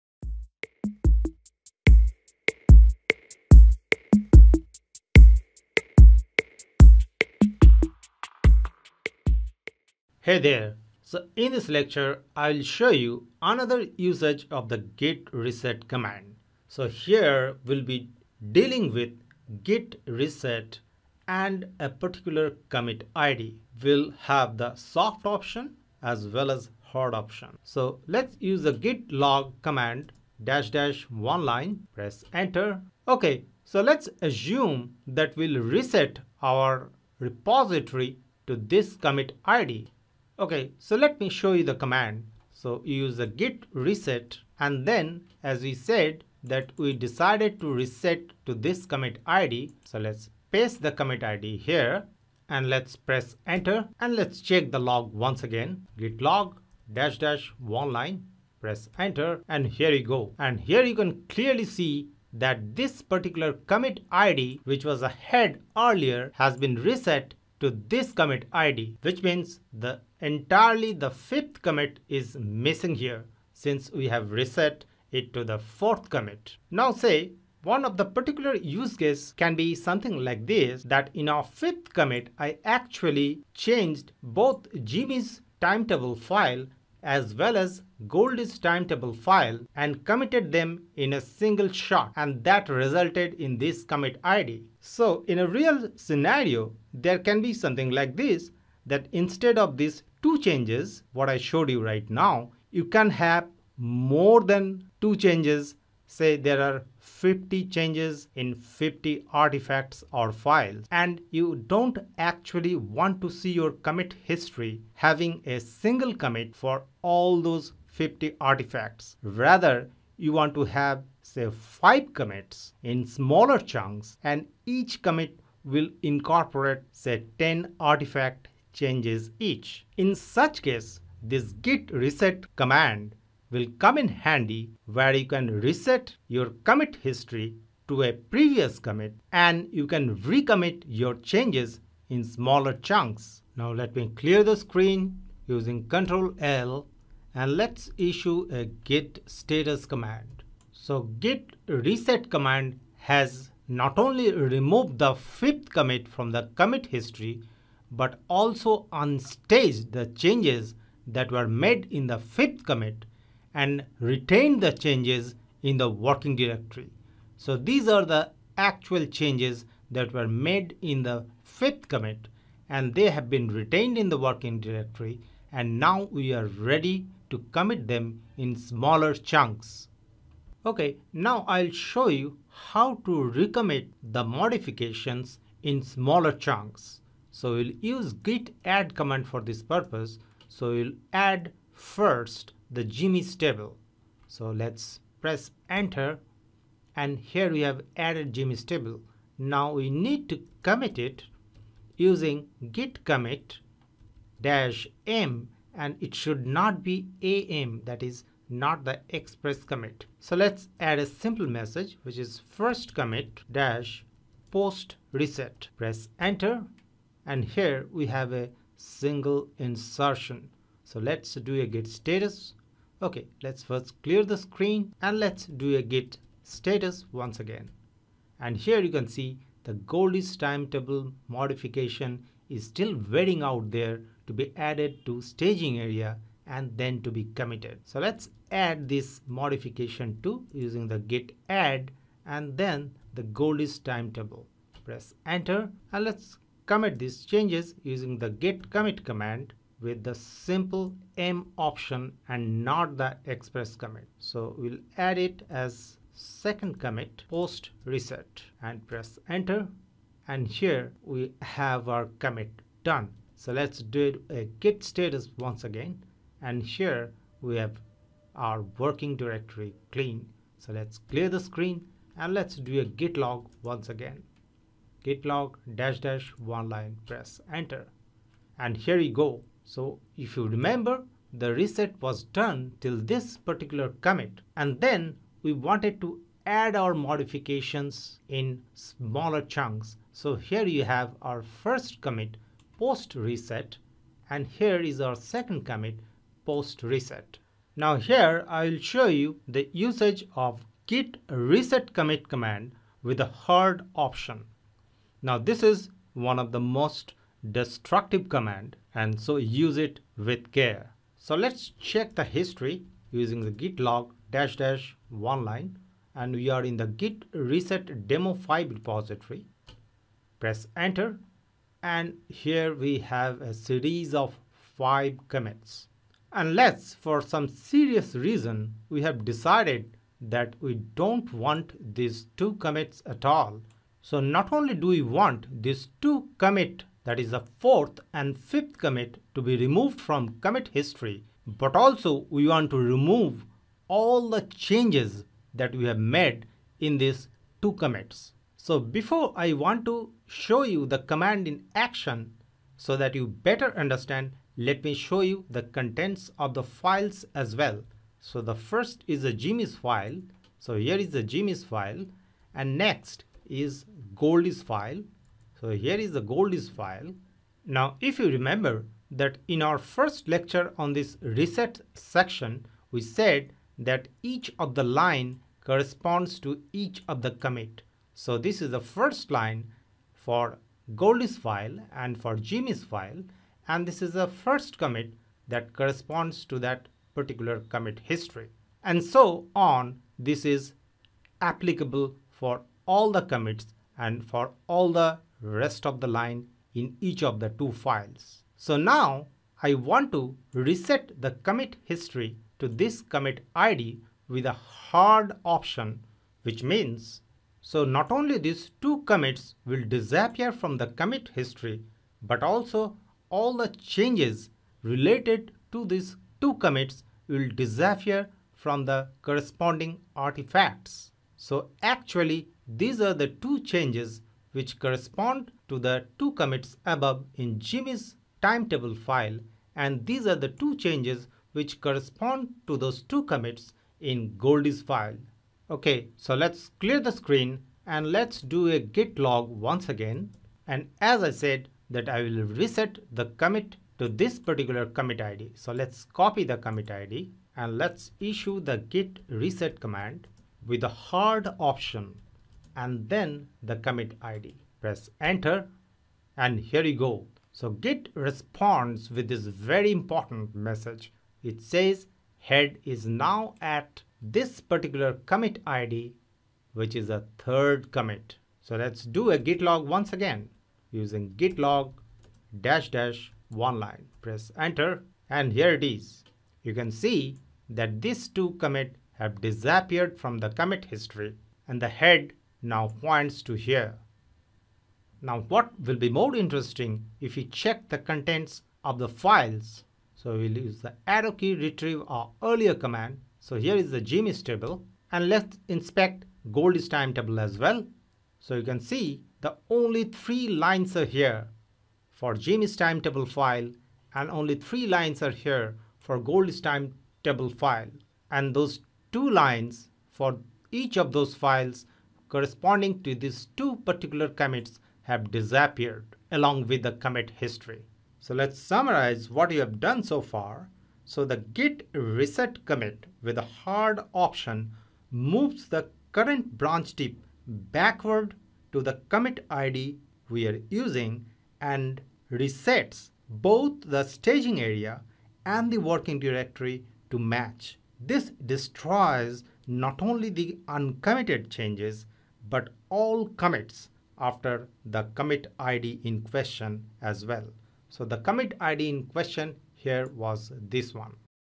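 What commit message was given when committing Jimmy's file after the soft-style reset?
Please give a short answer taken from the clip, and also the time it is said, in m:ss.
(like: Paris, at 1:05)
first commit post reset, at 3:32.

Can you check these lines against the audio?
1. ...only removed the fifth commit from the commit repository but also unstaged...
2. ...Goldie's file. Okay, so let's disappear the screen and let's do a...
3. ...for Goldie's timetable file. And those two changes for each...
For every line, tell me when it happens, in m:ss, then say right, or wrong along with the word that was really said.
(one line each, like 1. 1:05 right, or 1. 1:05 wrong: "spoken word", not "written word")
1. 2:33 wrong: "history", not "repository"
2. 7:14 wrong: "clear", not "disappear"
3. 8:25 wrong: "lines", not "changes".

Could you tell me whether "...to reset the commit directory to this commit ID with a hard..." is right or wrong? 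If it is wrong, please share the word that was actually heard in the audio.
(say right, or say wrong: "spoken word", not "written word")
wrong: "history", not "directory".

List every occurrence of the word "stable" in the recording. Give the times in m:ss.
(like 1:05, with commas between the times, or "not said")
3:13, 3:18.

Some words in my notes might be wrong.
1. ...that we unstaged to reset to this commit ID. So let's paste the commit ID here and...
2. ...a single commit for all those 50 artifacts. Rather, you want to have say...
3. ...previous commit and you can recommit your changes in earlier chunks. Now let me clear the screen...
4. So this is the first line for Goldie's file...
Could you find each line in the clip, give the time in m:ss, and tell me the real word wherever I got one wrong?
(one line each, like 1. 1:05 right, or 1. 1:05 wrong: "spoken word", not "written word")
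1. 0:46 wrong: "decided", not "unstaged"
2. 1:55 right
3. 2:18 wrong: "smaller", not "earlier"
4. 6:18 right.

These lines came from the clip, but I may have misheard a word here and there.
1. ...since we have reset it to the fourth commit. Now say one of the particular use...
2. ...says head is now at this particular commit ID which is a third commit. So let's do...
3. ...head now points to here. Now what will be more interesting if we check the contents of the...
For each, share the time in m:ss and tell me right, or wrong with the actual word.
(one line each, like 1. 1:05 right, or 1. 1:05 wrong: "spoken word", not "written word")
1. 1:13 right
2. 7:41 right
3. 8:01 right.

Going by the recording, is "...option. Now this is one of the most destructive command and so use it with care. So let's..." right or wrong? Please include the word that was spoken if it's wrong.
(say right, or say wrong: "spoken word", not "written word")
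right.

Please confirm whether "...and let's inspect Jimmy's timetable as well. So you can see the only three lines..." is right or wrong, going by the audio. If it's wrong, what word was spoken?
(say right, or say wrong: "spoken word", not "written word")
wrong: "Goldie", not "Jimmy".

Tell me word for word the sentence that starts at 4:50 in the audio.
So here you have our first commit post reset and here is our second commit post reset.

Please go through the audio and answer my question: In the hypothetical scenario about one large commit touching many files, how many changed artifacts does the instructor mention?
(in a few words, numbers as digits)
50.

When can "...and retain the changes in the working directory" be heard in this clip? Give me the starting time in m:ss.
2:43.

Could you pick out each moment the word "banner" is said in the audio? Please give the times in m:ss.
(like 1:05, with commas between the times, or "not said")
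not said.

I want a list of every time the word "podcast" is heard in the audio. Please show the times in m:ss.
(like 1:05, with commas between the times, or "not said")
not said.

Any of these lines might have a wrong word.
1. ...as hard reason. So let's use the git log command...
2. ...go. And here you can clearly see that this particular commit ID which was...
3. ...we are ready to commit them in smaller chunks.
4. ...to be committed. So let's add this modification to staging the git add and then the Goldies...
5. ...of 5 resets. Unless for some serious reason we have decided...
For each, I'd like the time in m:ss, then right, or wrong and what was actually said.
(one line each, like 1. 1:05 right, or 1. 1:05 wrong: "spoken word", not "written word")
1. 0:26 wrong: "option", not "reason"
2. 1:00 right
3. 2:56 right
4. 3:57 wrong: "using", not "staging"
5. 5:24 wrong: "commits", not "resets".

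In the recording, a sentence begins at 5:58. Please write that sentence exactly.
So the first is a Jimmy's file.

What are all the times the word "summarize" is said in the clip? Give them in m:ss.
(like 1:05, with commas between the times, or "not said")
8:38.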